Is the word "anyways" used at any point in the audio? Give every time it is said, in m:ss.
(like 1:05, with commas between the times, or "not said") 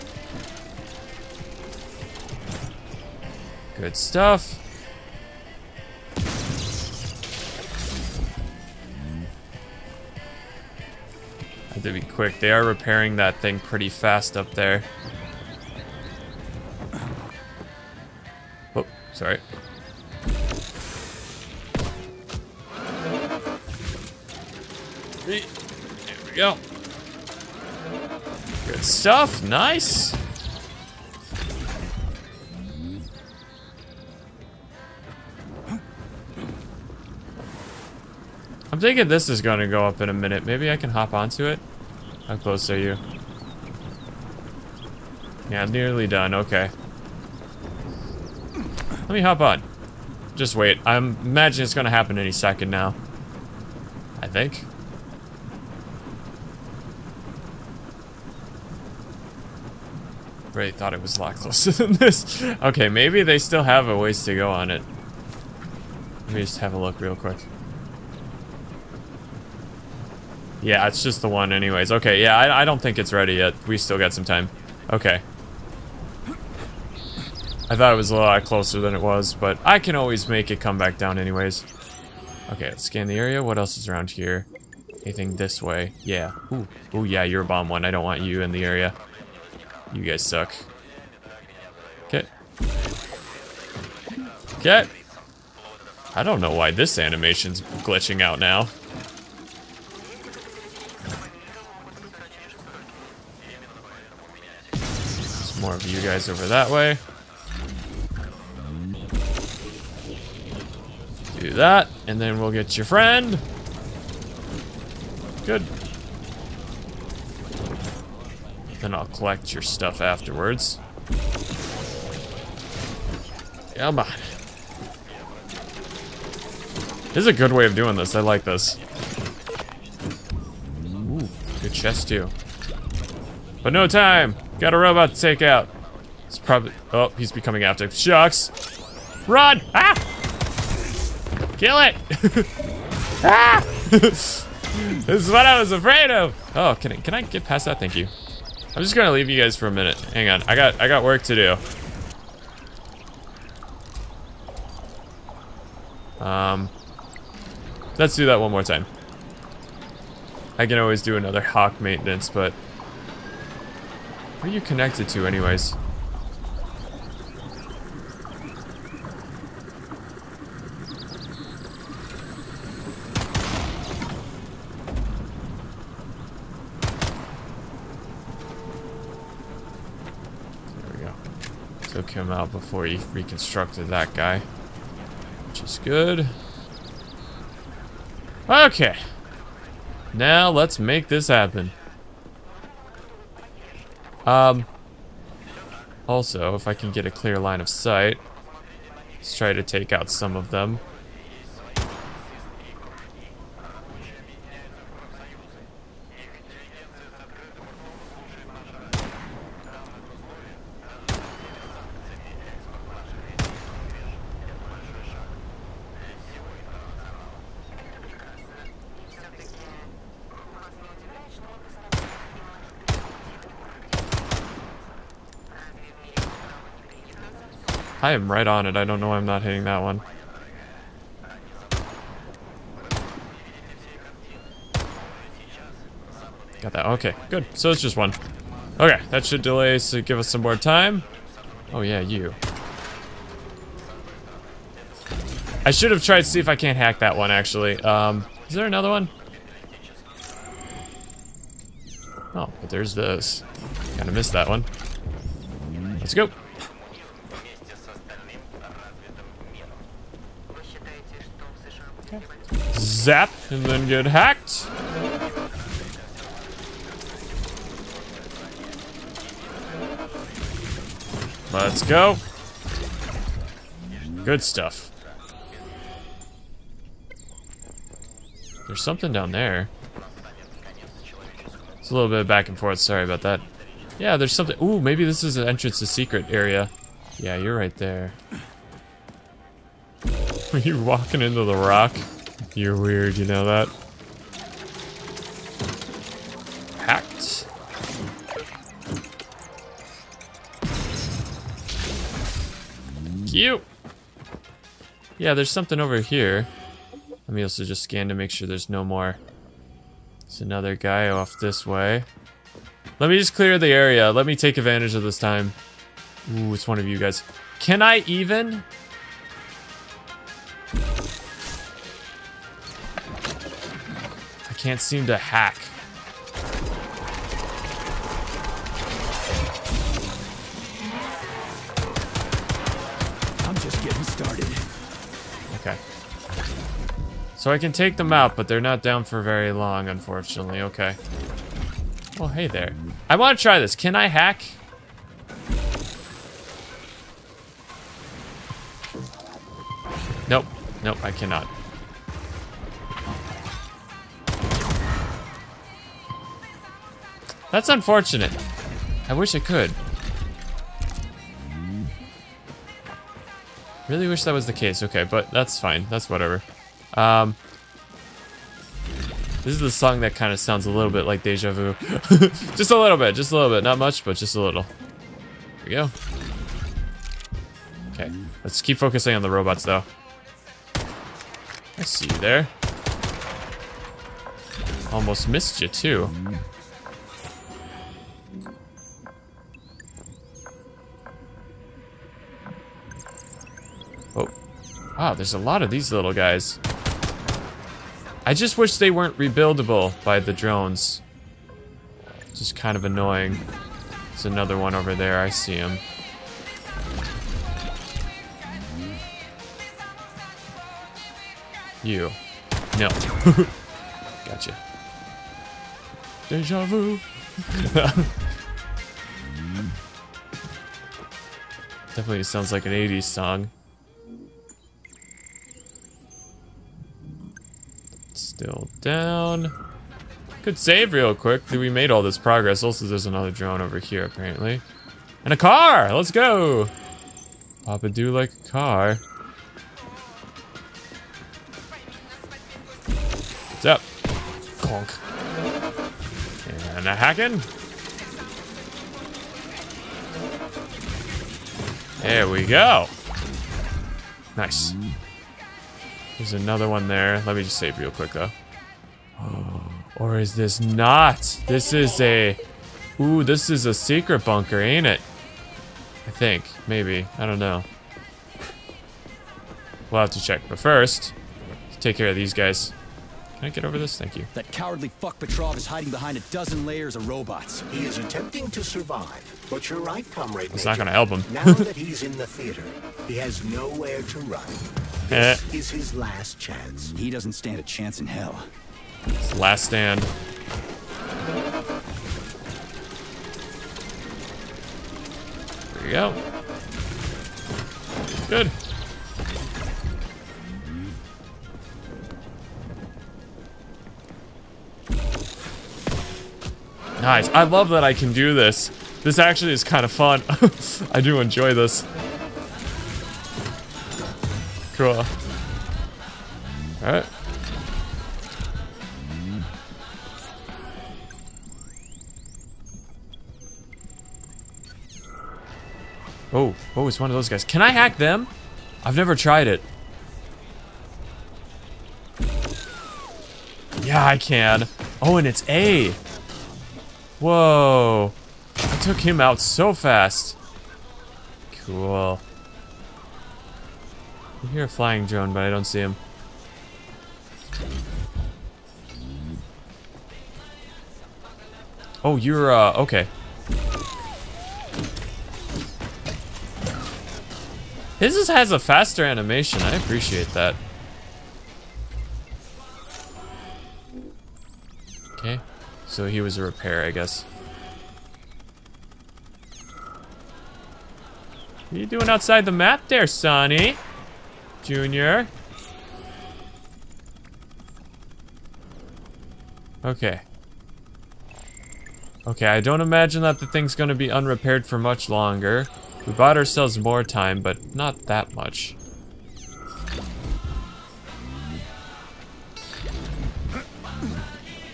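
1:11, 1:21, 2:45.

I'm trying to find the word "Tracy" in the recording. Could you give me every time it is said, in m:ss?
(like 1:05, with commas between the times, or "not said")
not said.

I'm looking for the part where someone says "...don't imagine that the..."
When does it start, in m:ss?
9:42.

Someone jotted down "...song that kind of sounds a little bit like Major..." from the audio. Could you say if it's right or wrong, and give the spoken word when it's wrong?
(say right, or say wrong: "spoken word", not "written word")
wrong: "Deja", not "Major".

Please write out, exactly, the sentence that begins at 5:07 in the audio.
Let me also just scan to make sure there's no more.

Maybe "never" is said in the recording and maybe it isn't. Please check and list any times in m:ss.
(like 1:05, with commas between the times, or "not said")
8:48.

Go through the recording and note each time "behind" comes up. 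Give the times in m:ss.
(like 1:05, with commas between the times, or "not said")
7:55.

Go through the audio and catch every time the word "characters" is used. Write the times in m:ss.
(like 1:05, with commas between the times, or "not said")
not said.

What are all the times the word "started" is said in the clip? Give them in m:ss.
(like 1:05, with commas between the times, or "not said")
5:34.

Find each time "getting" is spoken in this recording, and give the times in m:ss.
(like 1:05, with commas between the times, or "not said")
5:33.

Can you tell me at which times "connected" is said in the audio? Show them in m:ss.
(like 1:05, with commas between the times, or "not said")
2:44.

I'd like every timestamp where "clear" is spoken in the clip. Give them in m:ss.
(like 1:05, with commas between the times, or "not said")
3:17, 5:13.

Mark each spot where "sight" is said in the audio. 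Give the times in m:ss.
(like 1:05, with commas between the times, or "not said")
3:17.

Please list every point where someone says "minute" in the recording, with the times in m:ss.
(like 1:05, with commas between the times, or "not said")
0:40, 2:29.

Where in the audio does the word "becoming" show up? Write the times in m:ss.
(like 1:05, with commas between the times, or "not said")
2:17.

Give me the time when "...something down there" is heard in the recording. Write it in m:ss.
4:38.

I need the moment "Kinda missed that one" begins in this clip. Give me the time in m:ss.
4:13.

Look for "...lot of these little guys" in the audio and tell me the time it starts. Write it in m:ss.
6:35.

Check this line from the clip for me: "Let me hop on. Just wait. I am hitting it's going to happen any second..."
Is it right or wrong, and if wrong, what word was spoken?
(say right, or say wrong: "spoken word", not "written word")
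wrong: "imagining", not "hitting".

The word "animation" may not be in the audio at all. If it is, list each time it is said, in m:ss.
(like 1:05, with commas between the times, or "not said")
1:36, 9:19.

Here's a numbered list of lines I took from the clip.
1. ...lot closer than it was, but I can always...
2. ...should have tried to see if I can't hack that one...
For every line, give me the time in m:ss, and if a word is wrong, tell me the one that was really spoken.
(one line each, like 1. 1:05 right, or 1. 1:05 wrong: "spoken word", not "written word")
1. 1:18 right
2. 4:05 right.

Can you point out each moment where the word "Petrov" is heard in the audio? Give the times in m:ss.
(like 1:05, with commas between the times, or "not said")
7:55.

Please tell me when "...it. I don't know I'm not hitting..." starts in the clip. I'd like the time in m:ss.
3:48.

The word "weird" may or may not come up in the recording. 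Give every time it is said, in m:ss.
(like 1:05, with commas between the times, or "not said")
4:52.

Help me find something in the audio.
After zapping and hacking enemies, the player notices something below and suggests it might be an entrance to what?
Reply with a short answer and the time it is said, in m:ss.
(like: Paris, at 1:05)
secret area, at 4:45.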